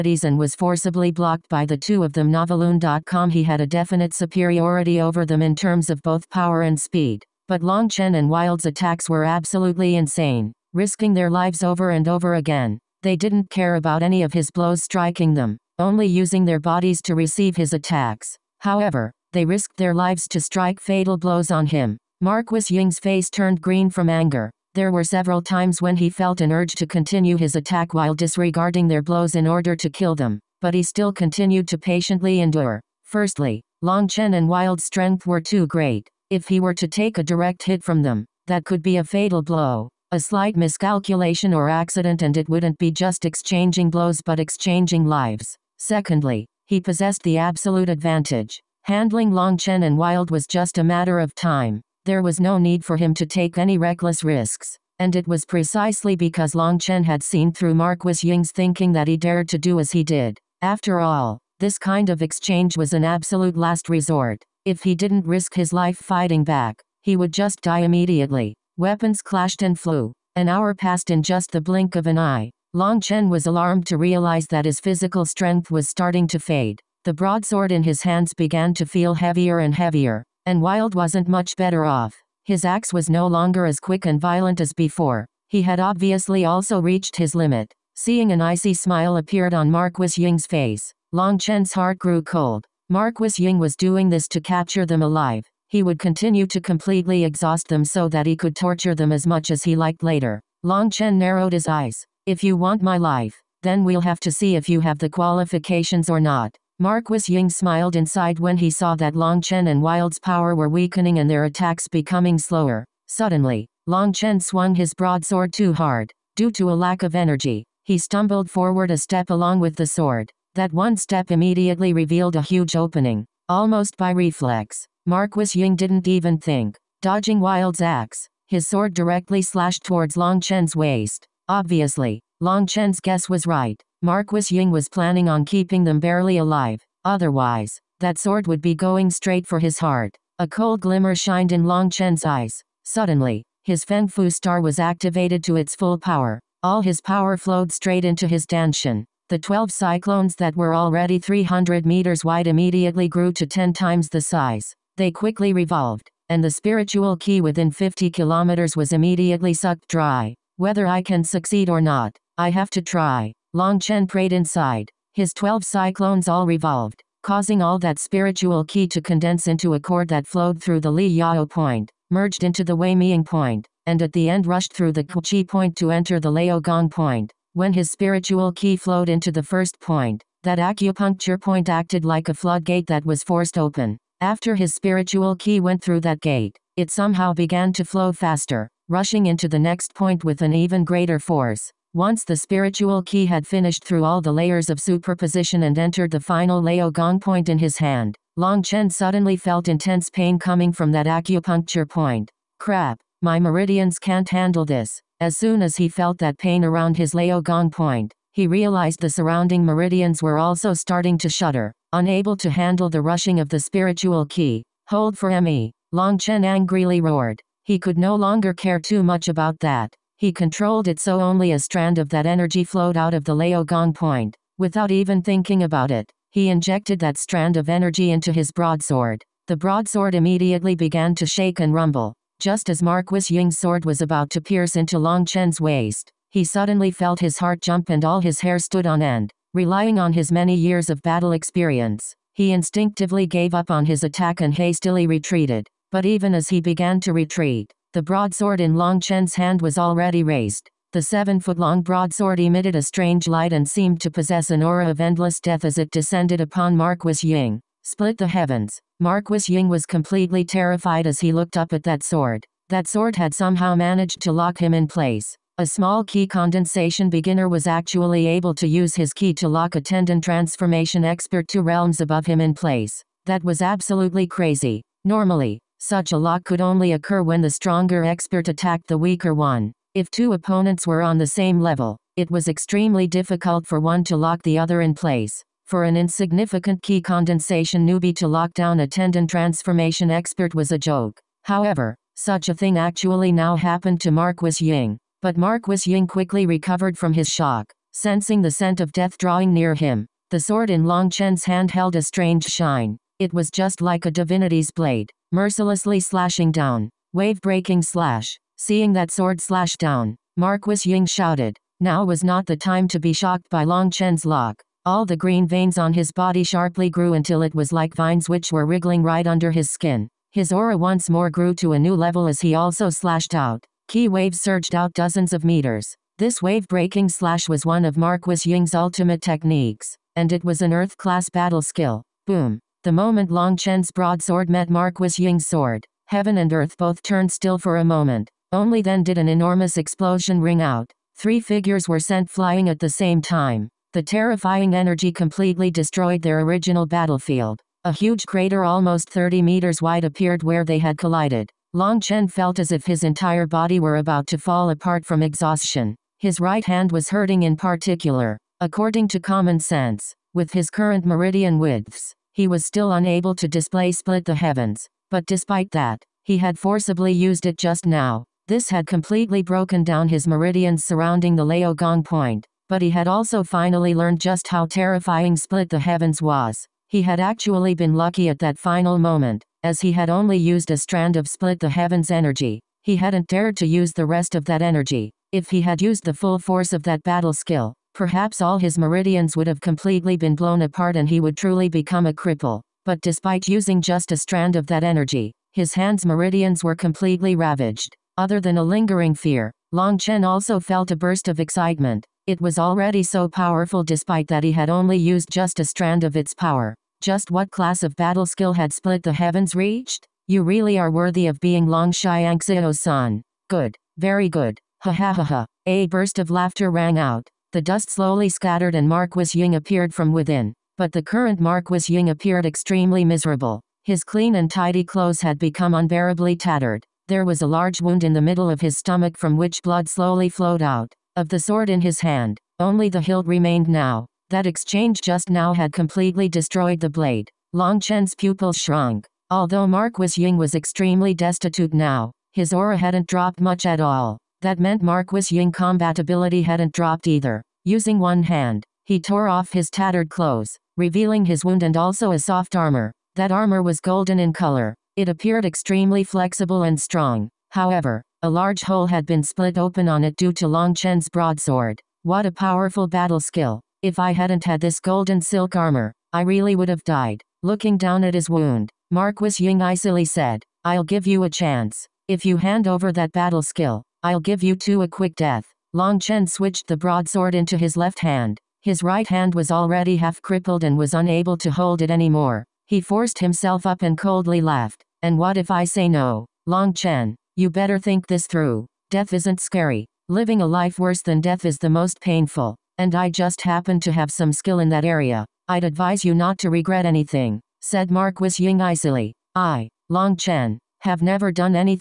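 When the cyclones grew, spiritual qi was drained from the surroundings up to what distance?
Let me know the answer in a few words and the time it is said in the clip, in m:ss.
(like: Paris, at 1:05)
50 kilometers, at 2:37.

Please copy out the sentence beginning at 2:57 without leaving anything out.
When his spiritual qi flowed into the first point, that acupuncture point acted like a floodgate that was forced open.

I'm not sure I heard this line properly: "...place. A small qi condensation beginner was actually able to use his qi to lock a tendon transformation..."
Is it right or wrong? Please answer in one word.
right.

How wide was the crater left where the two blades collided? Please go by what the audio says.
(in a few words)
30 meters.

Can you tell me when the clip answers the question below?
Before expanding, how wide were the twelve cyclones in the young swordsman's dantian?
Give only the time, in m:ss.
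2:31.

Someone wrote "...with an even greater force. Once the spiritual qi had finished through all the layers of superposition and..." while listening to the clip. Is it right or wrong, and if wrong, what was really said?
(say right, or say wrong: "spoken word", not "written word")
right.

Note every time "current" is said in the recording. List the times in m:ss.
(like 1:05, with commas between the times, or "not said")
6:00, 7:01.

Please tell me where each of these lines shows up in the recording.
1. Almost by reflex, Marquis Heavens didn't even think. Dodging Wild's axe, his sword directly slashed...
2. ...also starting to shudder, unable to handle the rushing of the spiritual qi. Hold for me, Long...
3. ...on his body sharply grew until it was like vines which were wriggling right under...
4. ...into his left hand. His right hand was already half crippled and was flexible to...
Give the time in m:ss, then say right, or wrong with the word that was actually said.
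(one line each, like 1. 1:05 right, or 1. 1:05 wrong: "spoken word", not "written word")
1. 2:03 wrong: "Ying", not "Heavens"
2. 3:30 right
3. 5:15 right
4. 7:57 wrong: "unable", not "flexible".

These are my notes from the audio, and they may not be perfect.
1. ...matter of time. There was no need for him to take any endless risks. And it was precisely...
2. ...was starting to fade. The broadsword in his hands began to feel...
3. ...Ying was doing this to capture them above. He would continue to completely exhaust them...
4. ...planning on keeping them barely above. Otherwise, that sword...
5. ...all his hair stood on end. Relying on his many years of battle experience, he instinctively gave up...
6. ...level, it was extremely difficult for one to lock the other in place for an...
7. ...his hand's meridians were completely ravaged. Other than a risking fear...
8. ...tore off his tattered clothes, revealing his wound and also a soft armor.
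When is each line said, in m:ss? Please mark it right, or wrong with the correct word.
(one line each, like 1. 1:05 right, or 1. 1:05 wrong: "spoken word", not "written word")
1. 0:50 wrong: "reckless", not "endless"
2. 1:15 right
3. 1:33 wrong: "alive", not "above"
4. 2:14 wrong: "alive", not "above"
5. 3:58 right
6. 4:41 right
7. 6:35 wrong: "lingering", not "risking"
8. 7:28 right.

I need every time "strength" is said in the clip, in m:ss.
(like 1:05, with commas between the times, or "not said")
0:34, 1:15.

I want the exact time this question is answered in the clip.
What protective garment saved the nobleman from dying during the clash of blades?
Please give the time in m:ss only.
7:44.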